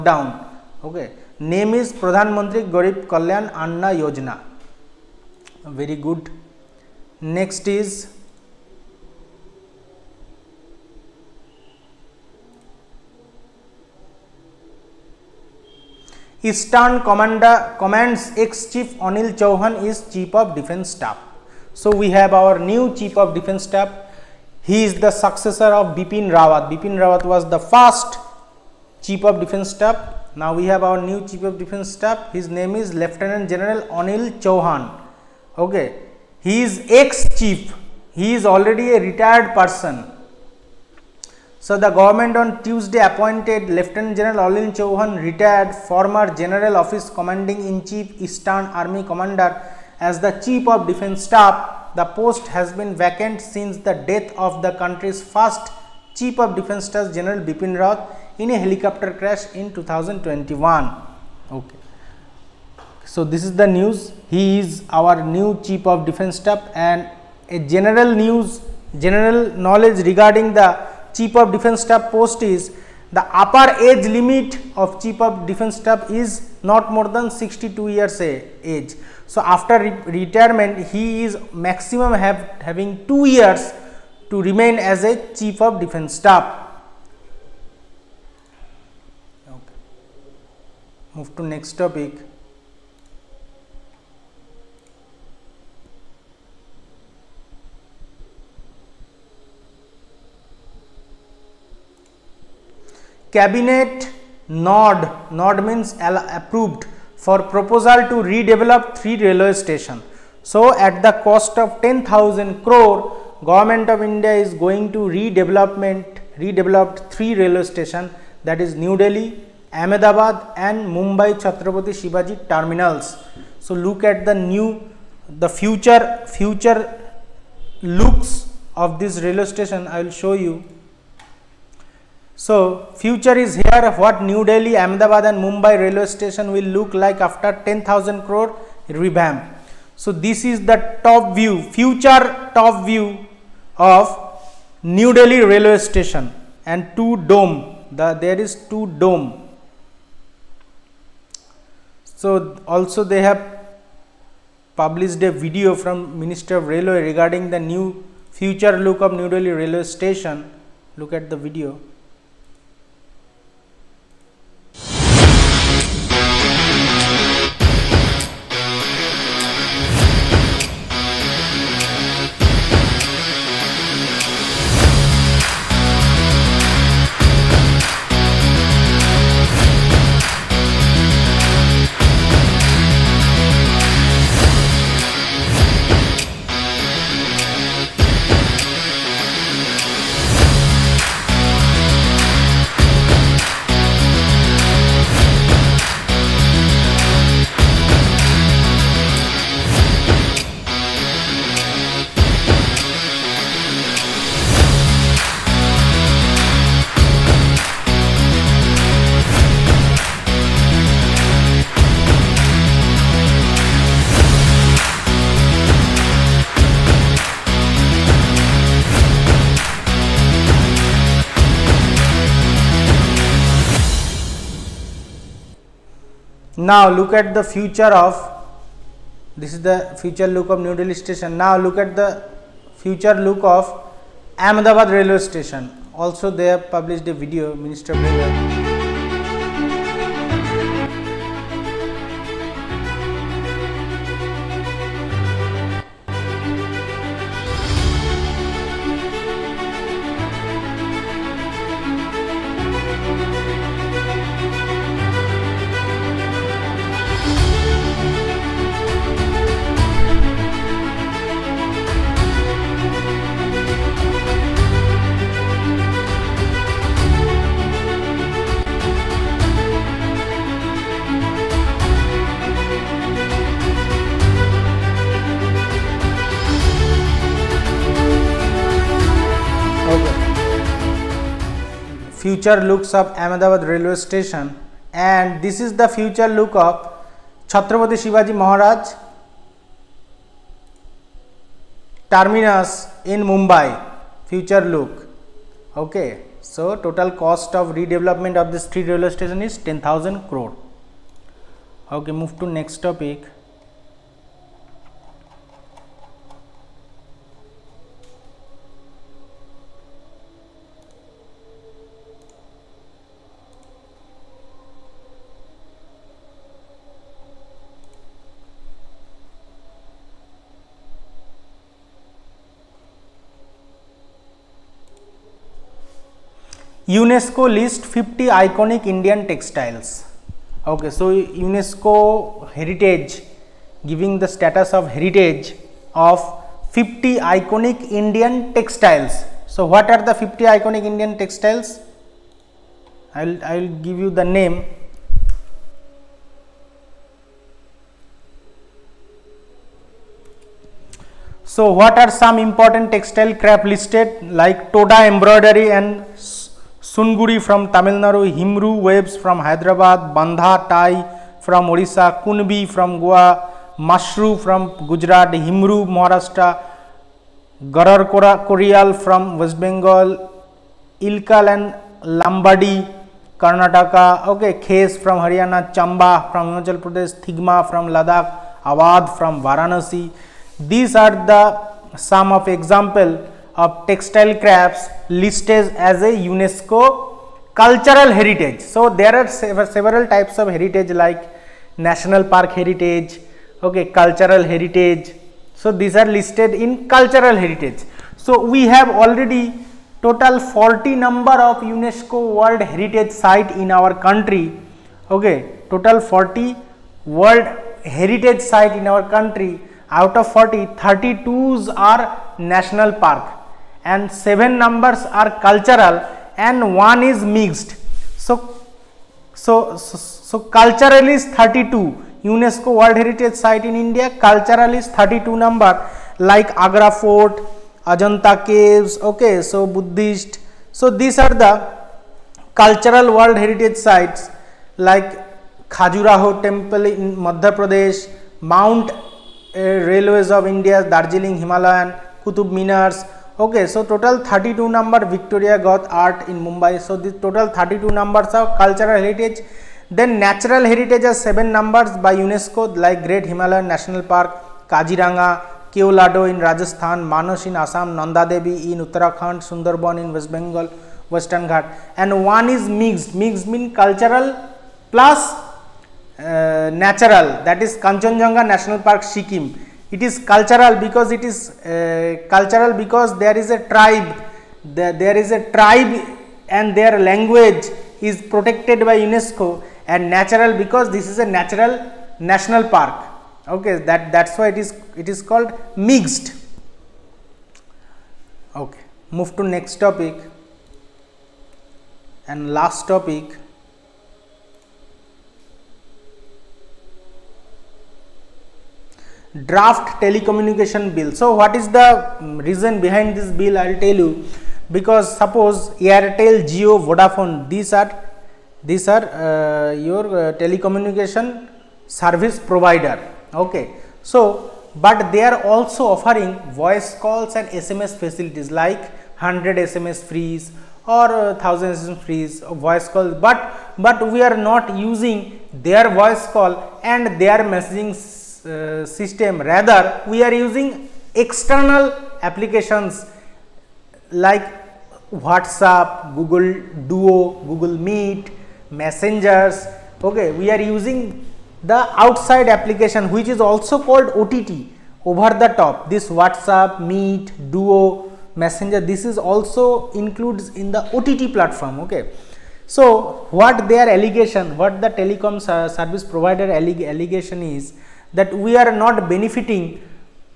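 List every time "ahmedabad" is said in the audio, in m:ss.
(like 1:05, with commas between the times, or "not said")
1:59, 2:14, 3:54, 4:43.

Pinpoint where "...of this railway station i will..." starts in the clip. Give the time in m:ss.
2:08.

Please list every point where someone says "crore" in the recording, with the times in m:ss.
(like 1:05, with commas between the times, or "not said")
1:52, 2:18, 5:00.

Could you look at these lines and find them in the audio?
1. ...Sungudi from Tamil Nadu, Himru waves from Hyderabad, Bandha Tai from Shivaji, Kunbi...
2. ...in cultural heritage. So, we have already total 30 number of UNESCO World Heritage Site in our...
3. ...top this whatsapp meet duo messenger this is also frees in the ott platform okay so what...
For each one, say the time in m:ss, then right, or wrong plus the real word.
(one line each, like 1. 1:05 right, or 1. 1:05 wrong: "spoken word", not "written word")
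1. 5:56 wrong: "Orissa", not "Shivaji"
2. 6:36 wrong: "40", not "30"
3. 9:05 wrong: "includes", not "frees".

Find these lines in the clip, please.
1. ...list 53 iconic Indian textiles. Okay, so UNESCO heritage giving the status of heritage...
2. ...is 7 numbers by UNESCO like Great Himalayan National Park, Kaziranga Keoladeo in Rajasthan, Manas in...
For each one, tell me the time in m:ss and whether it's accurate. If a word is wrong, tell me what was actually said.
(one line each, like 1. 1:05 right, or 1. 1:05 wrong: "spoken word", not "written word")
1. 5:27 wrong: "50", not "53"
2. 7:31 right.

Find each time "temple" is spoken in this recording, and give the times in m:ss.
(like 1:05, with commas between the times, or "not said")
7:16.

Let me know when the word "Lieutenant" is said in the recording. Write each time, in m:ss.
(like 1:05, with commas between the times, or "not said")
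0:32, 0:43.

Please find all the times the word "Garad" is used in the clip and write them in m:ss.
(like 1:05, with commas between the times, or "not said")
6:07.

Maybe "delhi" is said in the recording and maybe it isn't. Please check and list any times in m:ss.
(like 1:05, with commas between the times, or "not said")
1:59, 2:14, 2:25, 2:39, 3:50.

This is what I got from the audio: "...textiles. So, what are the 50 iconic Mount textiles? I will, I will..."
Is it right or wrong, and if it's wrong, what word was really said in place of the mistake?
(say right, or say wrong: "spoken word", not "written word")
wrong: "Indian", not "Mount".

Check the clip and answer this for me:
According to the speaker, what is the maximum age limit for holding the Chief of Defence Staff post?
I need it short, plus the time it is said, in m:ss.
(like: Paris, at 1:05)
62 years, at 1:17.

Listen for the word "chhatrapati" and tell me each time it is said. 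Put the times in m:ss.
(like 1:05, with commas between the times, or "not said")
2:01, 4:47.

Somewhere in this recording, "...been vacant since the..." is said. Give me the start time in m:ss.
0:52.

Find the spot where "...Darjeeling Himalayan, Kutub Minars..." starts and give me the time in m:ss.
7:20.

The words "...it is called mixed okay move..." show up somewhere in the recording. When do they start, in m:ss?
8:04.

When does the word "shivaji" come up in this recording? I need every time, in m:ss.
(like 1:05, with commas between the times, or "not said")
2:02, 4:48.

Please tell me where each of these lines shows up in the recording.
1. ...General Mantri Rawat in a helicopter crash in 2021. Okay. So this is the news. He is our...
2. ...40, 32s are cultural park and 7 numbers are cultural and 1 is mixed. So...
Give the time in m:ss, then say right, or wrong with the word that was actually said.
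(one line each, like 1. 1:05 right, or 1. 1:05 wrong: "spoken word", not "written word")
1. 0:57 wrong: "Bipin", not "Mantri"
2. 6:50 wrong: "national", not "cultural".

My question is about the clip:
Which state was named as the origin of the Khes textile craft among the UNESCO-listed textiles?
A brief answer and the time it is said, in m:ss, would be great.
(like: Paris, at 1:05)
Haryana, at 6:15.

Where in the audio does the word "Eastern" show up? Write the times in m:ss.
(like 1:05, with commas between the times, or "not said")
0:16, 0:48.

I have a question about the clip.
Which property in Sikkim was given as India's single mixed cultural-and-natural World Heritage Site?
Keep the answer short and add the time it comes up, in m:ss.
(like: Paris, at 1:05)
Kanchenjunga National Park, at 7:47.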